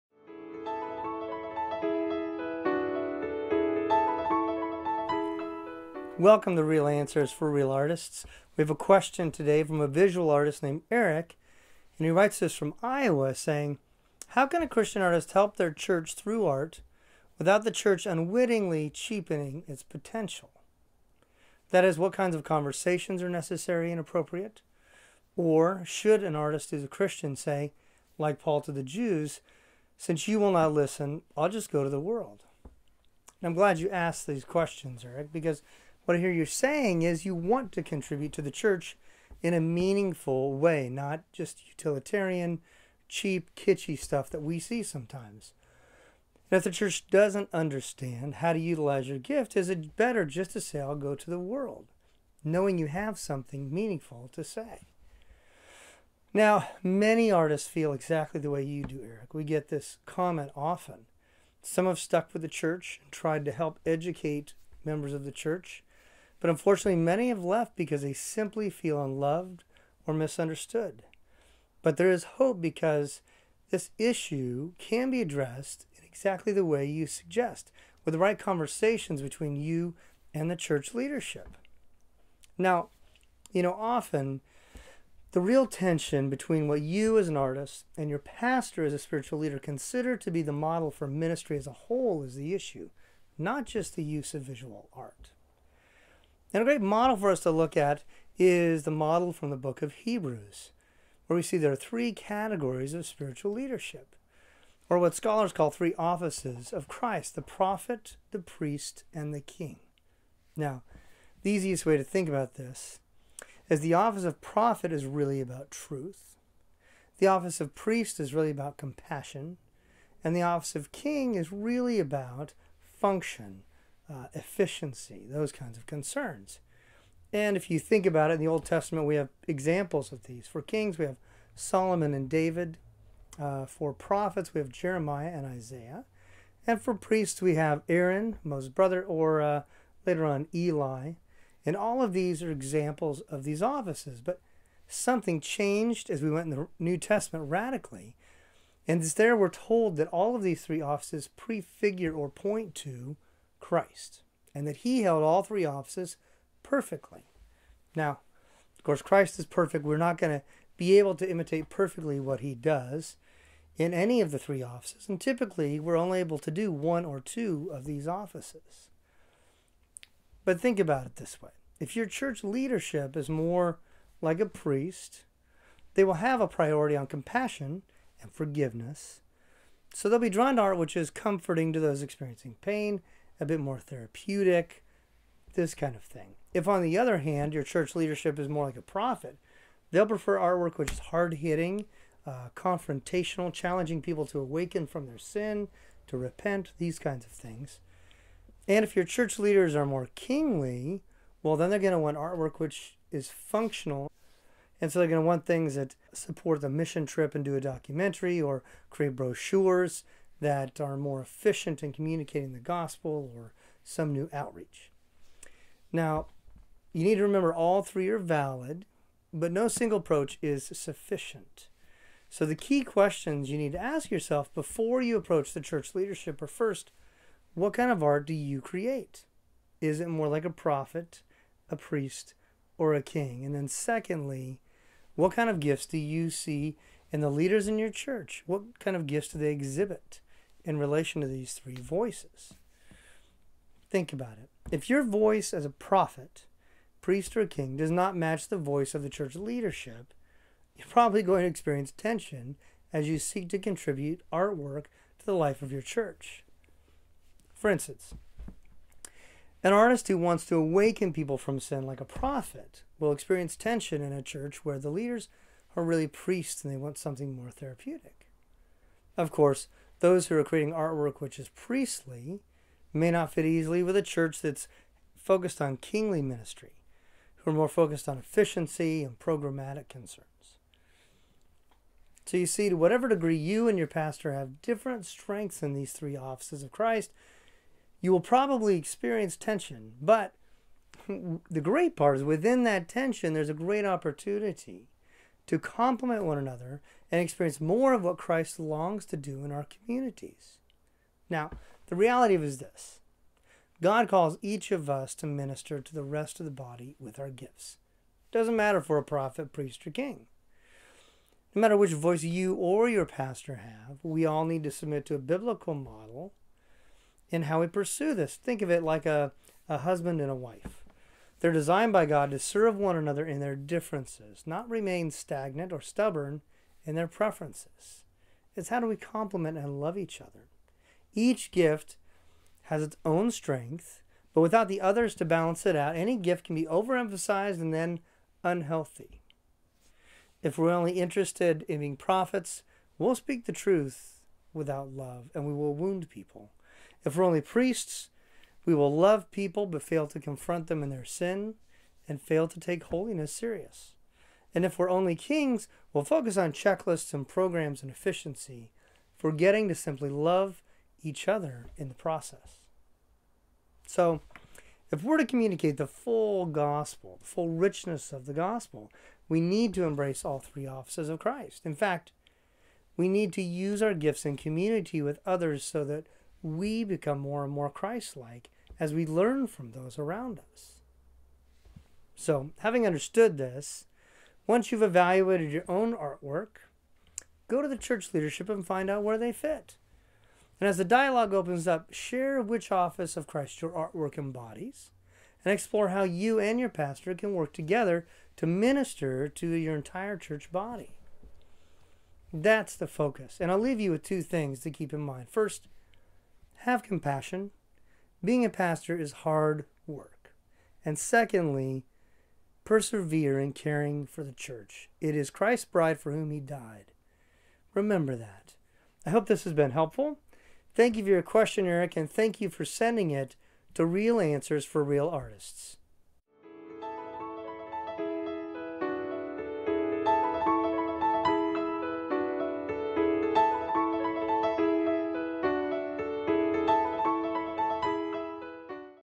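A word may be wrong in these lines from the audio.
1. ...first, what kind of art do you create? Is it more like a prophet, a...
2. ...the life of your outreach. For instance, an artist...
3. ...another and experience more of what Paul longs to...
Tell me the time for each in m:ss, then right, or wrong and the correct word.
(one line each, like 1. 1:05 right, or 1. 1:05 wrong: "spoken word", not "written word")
1. 3:46 right
2. 4:15 wrong: "church", not "outreach"
3. 4:56 wrong: "Christ", not "Paul".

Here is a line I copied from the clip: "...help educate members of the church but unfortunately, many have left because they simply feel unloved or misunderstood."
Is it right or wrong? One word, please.
right.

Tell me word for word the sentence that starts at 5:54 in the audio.
And if we're only kings, we'll focus on checklists and programs and efficiency, forgetting to simply love each other in the process.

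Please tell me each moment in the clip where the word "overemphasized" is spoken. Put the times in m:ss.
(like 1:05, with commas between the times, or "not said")
5:36.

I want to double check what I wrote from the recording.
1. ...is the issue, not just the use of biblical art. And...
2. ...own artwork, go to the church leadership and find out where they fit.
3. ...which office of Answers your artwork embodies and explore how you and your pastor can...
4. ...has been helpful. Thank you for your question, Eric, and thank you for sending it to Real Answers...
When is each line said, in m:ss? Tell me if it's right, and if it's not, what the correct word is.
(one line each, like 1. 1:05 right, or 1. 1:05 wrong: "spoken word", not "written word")
1. 1:32 wrong: "visual", not "biblical"
2. 6:25 right
3. 6:32 wrong: "Christ", not "Answers"
4. 6:59 right.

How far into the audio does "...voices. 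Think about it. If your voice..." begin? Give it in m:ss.
4:01.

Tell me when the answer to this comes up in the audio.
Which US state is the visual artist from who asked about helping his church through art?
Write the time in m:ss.
0:12.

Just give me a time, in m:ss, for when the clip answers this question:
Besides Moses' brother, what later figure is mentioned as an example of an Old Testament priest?
2:20.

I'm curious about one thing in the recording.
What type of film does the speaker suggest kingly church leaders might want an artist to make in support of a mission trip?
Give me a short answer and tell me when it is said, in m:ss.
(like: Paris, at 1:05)
A documentary, at 3:27.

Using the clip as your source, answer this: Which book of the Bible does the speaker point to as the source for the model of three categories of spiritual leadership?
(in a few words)
Hebrews.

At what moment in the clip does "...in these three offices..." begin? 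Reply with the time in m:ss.
4:45.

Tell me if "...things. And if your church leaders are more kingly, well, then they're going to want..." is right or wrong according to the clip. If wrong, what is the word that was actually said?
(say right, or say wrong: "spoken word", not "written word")
right.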